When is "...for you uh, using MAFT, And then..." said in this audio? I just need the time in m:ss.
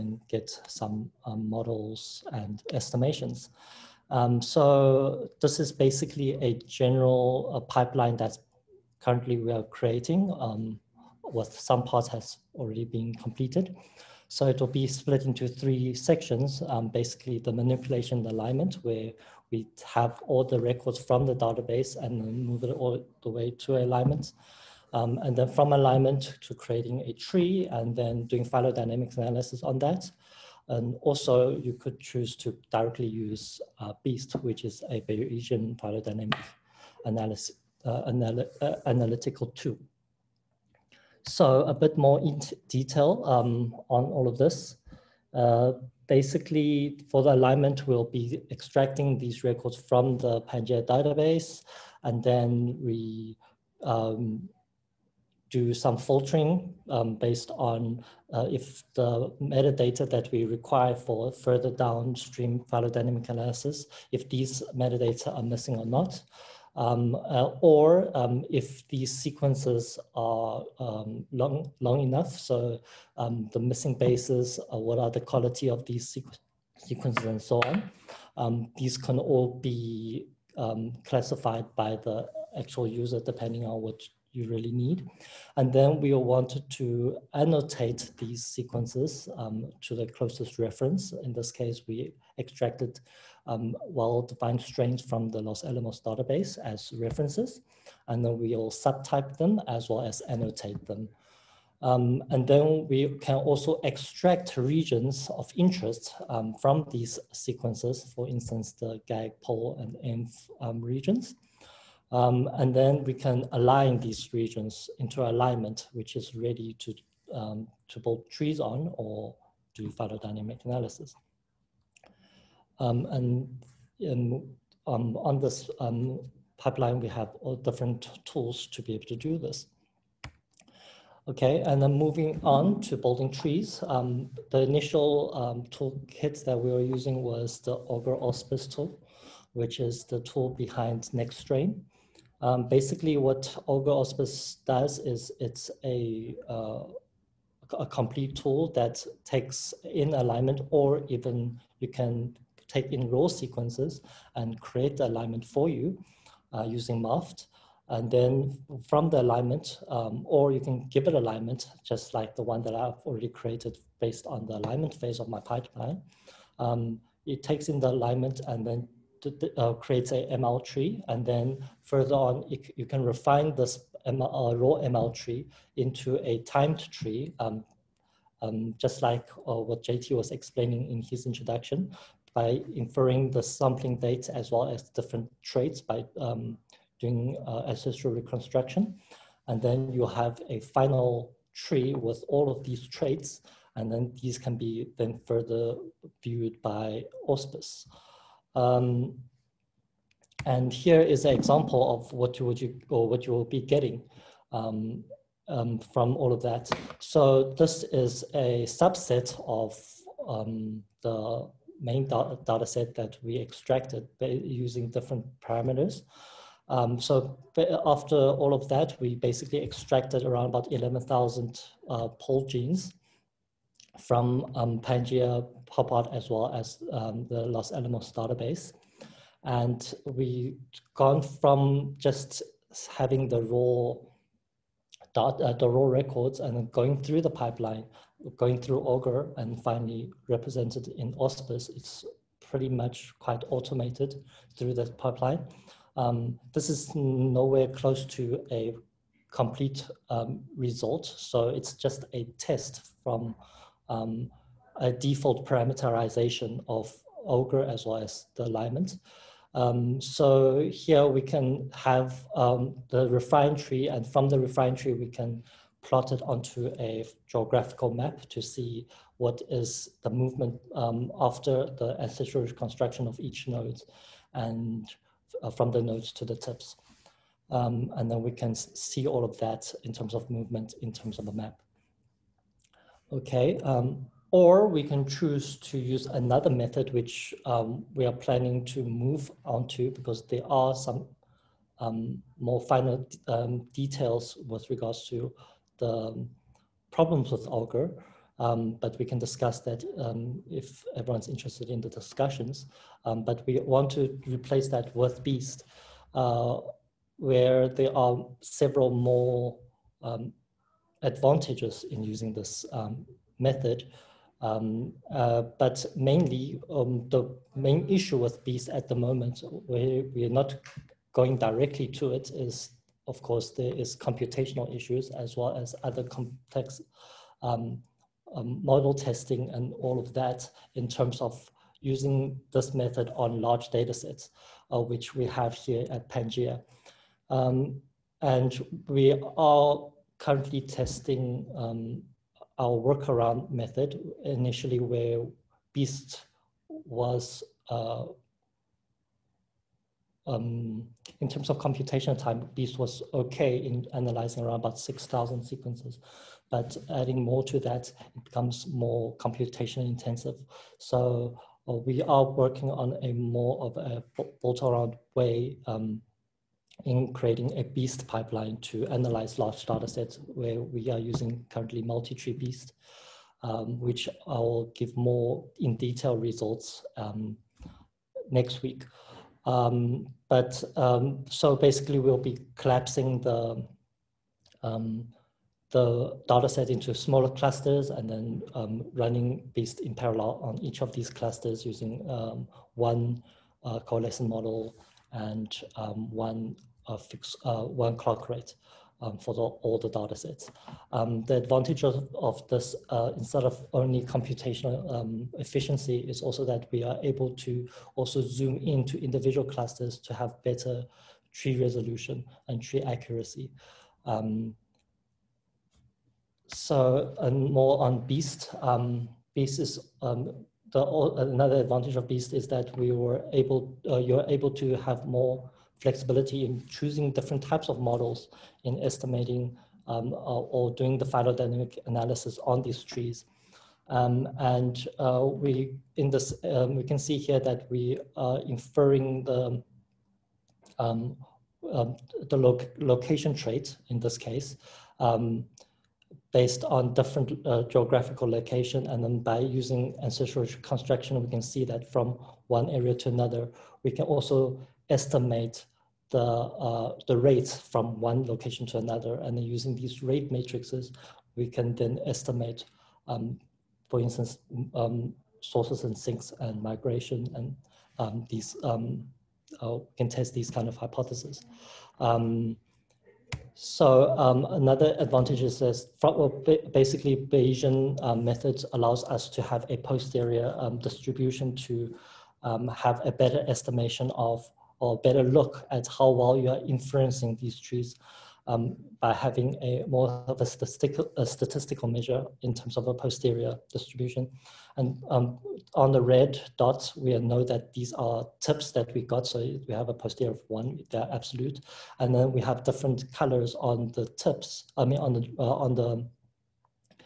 2:35.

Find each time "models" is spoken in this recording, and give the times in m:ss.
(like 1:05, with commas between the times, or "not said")
0:01, 5:28, 6:34, 7:07.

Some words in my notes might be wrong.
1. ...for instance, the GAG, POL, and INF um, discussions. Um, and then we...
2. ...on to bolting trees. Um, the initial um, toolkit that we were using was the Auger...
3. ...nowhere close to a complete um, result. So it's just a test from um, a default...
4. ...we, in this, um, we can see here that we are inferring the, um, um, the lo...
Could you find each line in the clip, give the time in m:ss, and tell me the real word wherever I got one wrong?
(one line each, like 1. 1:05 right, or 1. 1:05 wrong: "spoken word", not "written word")
1. 1:48 wrong: "regions", not "discussions"
2. 2:12 right
3. 4:06 right
4. 7:15 right.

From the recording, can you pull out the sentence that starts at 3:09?
And then you have a final tree with all of these traits, and then these can be then further viewed by auspice.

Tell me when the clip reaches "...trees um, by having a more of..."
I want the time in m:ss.
8:07.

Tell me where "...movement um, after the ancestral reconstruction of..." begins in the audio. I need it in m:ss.
4:30.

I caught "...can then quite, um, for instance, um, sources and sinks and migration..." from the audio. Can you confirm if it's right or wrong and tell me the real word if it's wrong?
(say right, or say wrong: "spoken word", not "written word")
wrong: "estimate", not "quite".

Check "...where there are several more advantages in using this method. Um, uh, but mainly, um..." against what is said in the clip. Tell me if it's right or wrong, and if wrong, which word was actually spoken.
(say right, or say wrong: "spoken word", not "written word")
right.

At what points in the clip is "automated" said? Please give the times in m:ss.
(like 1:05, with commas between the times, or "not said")
4:03.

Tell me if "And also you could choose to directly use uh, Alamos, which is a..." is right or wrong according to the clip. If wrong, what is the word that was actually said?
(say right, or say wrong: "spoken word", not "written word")
wrong: "BEAST", not "Alamos".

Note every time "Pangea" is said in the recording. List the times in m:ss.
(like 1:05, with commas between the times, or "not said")
0:50, 3:44, 5:36.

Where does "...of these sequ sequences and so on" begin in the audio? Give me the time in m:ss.
1:15.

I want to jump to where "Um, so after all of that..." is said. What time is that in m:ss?
3:36.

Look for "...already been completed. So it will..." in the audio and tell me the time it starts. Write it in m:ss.
0:12.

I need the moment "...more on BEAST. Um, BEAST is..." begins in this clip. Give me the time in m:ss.
6:57.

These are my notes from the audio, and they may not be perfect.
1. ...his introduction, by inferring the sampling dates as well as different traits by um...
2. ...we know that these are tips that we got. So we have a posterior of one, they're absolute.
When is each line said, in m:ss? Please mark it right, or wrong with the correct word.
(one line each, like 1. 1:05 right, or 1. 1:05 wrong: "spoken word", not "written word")
1. 3:01 right
2. 8:16 right.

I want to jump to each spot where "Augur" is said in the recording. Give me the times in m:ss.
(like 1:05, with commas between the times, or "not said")
2:23, 3:58, 4:57.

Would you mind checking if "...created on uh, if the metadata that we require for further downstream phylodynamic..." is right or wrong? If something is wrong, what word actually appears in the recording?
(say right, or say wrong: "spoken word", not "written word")
wrong: "based", not "created".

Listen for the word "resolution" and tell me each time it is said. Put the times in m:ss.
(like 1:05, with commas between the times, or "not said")
6:51.